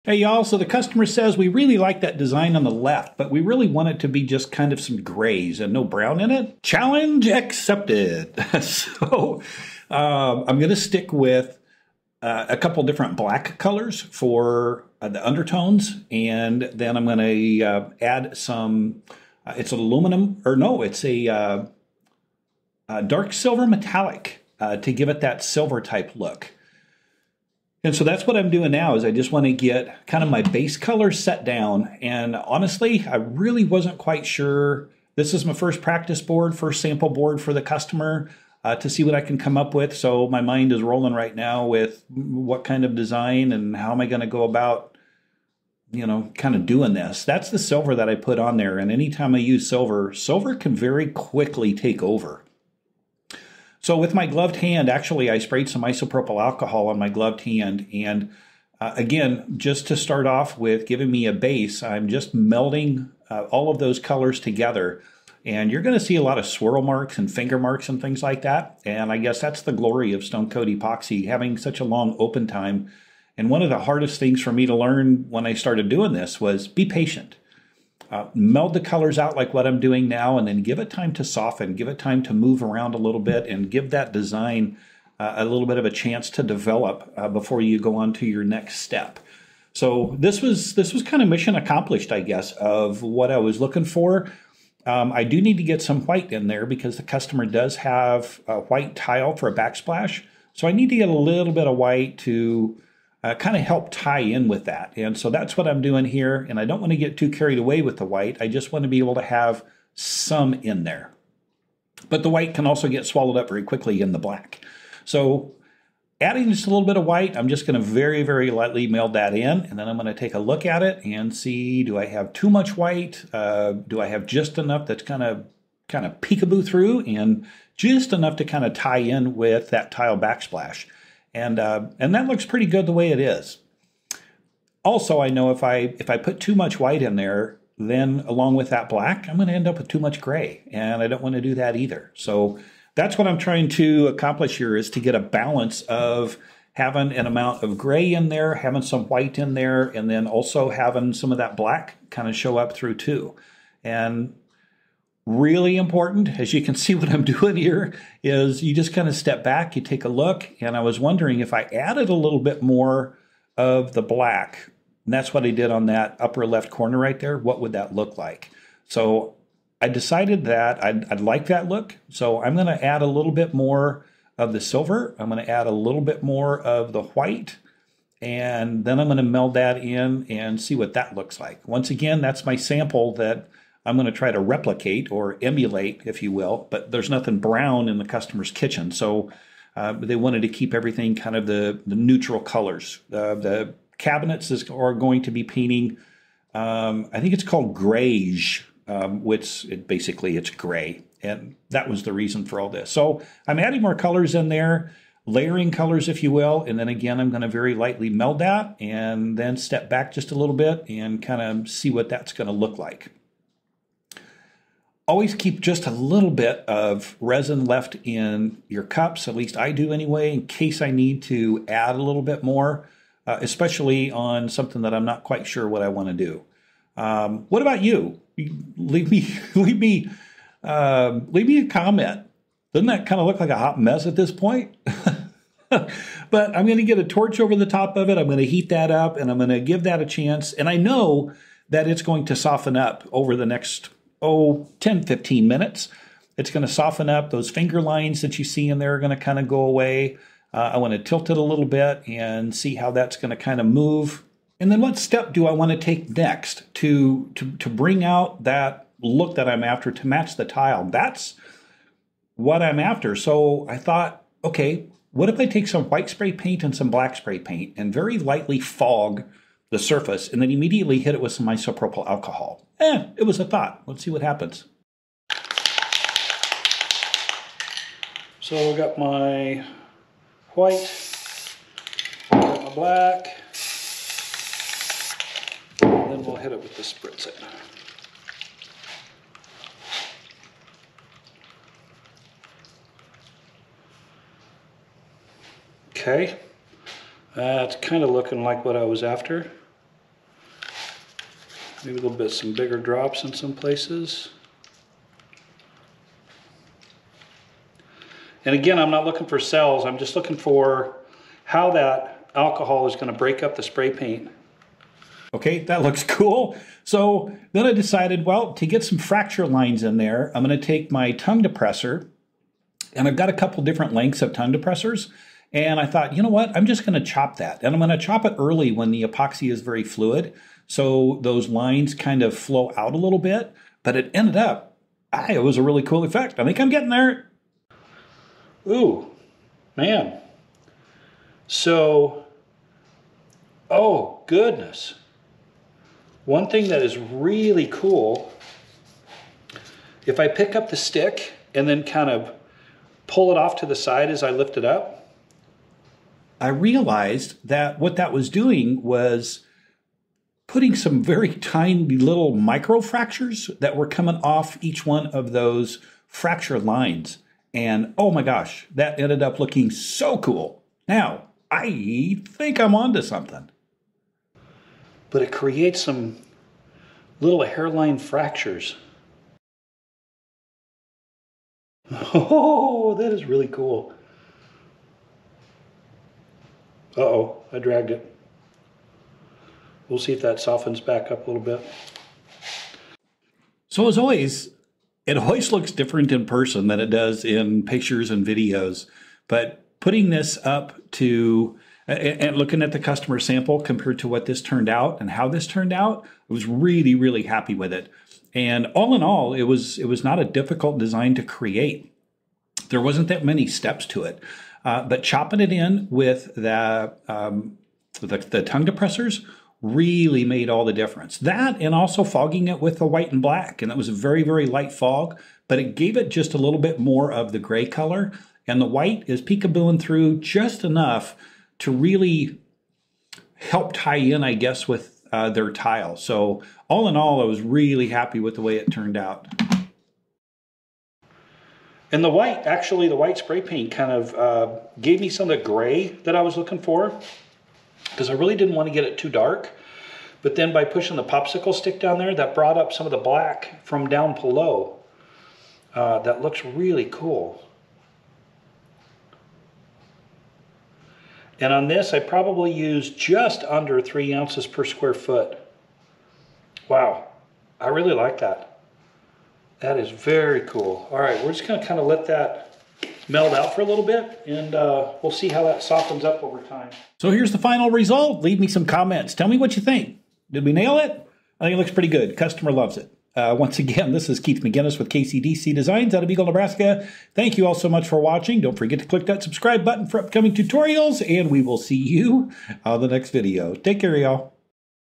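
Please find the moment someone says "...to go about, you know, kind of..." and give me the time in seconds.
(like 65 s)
44 s.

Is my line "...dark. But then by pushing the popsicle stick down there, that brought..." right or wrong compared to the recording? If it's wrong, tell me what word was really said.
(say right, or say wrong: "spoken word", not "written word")
right.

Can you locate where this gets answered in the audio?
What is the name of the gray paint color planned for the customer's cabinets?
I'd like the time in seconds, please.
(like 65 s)
197 s.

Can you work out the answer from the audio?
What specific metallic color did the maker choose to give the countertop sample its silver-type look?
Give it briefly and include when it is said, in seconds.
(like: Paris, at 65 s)
dark silver metallic, at 23 s.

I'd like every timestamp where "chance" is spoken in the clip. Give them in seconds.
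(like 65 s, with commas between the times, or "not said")
85 s, 240 s.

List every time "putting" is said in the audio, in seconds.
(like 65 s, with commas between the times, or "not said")
360 s, 399 s.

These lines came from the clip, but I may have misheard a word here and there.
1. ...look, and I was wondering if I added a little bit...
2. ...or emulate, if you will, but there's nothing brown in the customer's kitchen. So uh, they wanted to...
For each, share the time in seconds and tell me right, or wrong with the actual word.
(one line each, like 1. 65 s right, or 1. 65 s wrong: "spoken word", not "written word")
1. 160 s right
2. 185 s right.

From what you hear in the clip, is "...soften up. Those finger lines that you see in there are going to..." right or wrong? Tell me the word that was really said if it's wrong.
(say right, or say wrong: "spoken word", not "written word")
right.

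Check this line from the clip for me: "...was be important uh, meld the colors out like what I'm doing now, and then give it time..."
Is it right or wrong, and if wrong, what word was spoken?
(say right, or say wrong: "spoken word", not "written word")
wrong: "patient", not "important".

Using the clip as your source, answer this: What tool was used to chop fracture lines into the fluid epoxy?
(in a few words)
tongue depressor.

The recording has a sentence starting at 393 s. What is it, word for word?
So as always, it always looks different in person than it does in pictures and videos.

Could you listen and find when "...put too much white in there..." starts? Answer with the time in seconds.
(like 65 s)
136 s.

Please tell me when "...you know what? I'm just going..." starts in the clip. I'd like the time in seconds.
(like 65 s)
326 s.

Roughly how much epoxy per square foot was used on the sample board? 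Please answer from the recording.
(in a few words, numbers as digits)
just under 3 ounces.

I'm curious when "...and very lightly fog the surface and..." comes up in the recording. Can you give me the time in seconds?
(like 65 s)
267 s.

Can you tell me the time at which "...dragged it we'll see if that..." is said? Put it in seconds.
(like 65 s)
387 s.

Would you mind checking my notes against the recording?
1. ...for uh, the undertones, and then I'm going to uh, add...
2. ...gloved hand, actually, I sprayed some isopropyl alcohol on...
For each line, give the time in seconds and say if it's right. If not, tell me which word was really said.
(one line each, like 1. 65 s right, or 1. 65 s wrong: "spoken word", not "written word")
1. 14 s right
2. 54 s right.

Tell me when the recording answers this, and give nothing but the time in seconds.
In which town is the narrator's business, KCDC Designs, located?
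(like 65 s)
486 s.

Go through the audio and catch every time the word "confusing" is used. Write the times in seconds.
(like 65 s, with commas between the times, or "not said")
not said.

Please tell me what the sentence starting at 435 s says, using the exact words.
So all in all, I was really happy with the way it turned out.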